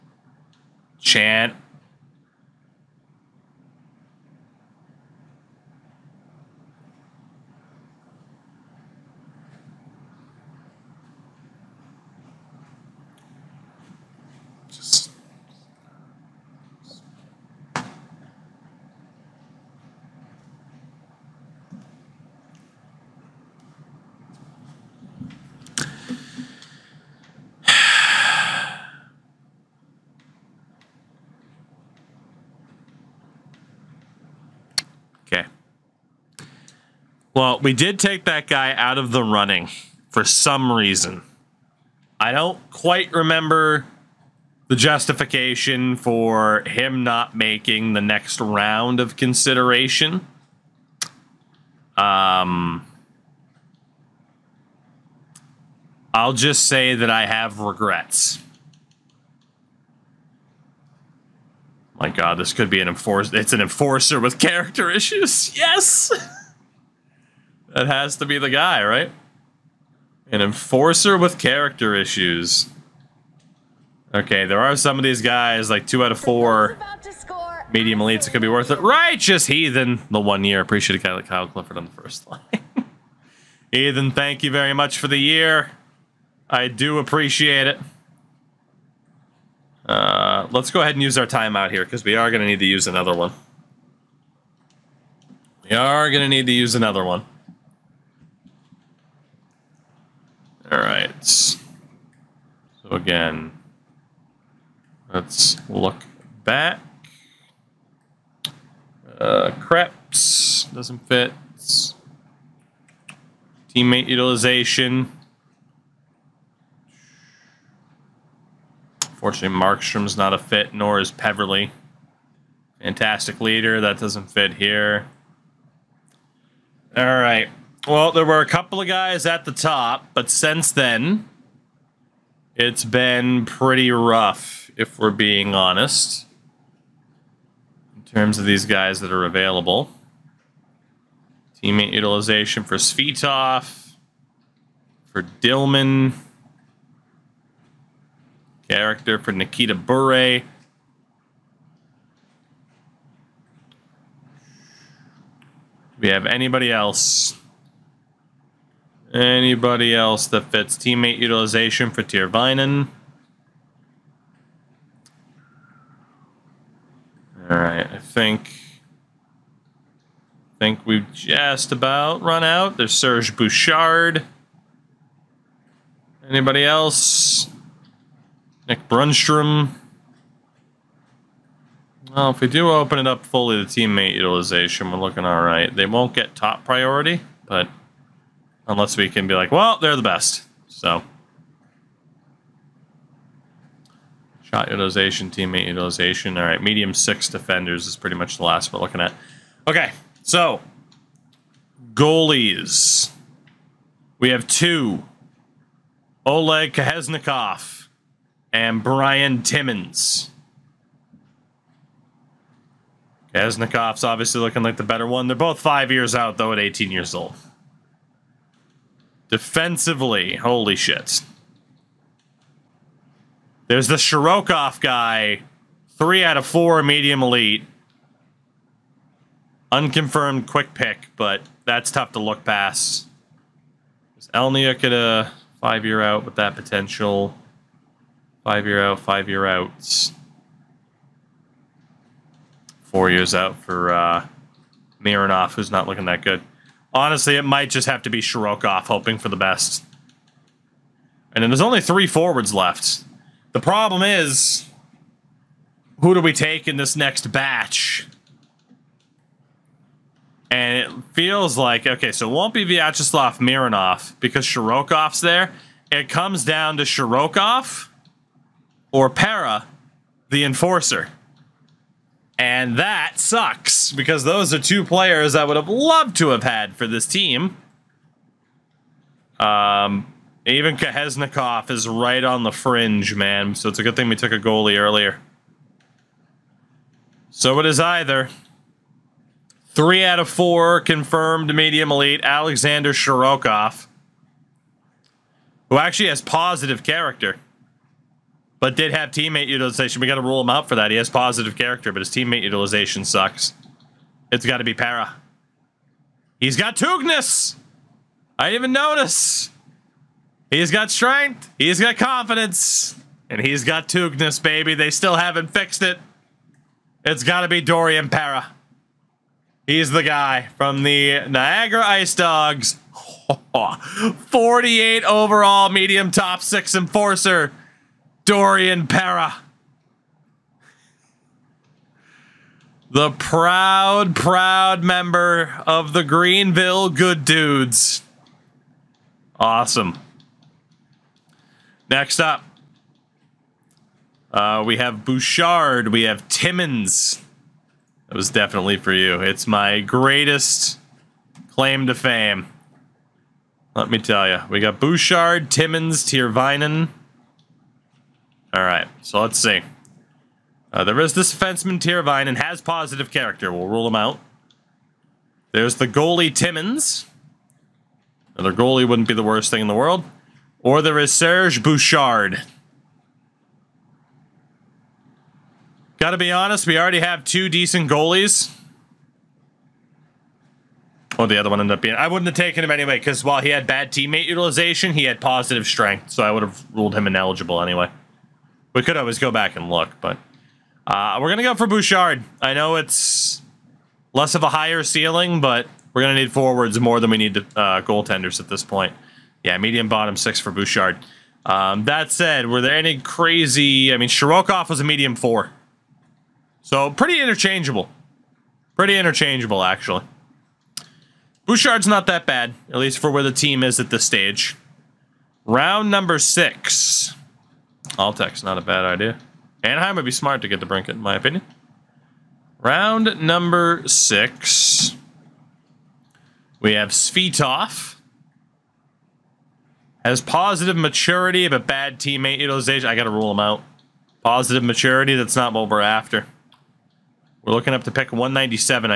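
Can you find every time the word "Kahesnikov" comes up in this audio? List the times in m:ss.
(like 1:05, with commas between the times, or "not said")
3:26, 4:40.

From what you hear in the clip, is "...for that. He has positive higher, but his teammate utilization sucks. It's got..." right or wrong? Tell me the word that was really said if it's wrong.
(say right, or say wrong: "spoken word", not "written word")
wrong: "character", not "higher".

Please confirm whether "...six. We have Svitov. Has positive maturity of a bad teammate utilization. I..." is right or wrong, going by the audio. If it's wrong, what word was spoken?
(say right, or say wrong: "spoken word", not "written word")
right.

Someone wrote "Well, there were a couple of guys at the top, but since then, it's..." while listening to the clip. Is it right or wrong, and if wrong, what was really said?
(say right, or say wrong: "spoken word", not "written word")
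right.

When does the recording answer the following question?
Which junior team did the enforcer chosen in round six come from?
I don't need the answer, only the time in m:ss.
5:20.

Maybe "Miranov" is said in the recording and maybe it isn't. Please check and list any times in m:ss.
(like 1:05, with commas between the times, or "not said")
4:04, 4:23.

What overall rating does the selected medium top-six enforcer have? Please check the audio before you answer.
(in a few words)
48.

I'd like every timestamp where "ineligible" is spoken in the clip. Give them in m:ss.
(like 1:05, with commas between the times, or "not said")
6:27.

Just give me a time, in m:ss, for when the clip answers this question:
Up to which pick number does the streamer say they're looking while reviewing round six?
7:18.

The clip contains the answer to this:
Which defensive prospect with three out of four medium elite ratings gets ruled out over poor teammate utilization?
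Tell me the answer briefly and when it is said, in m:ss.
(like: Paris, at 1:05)
Alexander Shirokov, at 4:52.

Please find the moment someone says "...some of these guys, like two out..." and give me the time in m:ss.
1:14.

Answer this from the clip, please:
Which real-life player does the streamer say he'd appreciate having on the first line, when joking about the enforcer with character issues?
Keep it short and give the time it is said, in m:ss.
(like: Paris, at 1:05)
Kyle Clifford, at 1:21.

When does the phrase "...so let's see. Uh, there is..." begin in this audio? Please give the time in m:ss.
5:59.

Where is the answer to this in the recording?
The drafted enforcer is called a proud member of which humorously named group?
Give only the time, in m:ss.
5:36.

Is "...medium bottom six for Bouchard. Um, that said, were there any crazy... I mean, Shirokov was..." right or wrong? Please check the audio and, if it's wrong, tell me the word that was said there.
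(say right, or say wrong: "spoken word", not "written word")
right.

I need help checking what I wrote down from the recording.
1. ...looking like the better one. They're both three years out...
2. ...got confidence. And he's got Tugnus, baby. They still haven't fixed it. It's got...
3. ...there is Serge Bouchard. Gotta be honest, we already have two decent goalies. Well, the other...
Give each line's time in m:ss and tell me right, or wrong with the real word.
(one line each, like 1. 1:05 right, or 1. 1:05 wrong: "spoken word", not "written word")
1. 3:34 wrong: "five", not "three"
2. 5:11 right
3. 6:10 right.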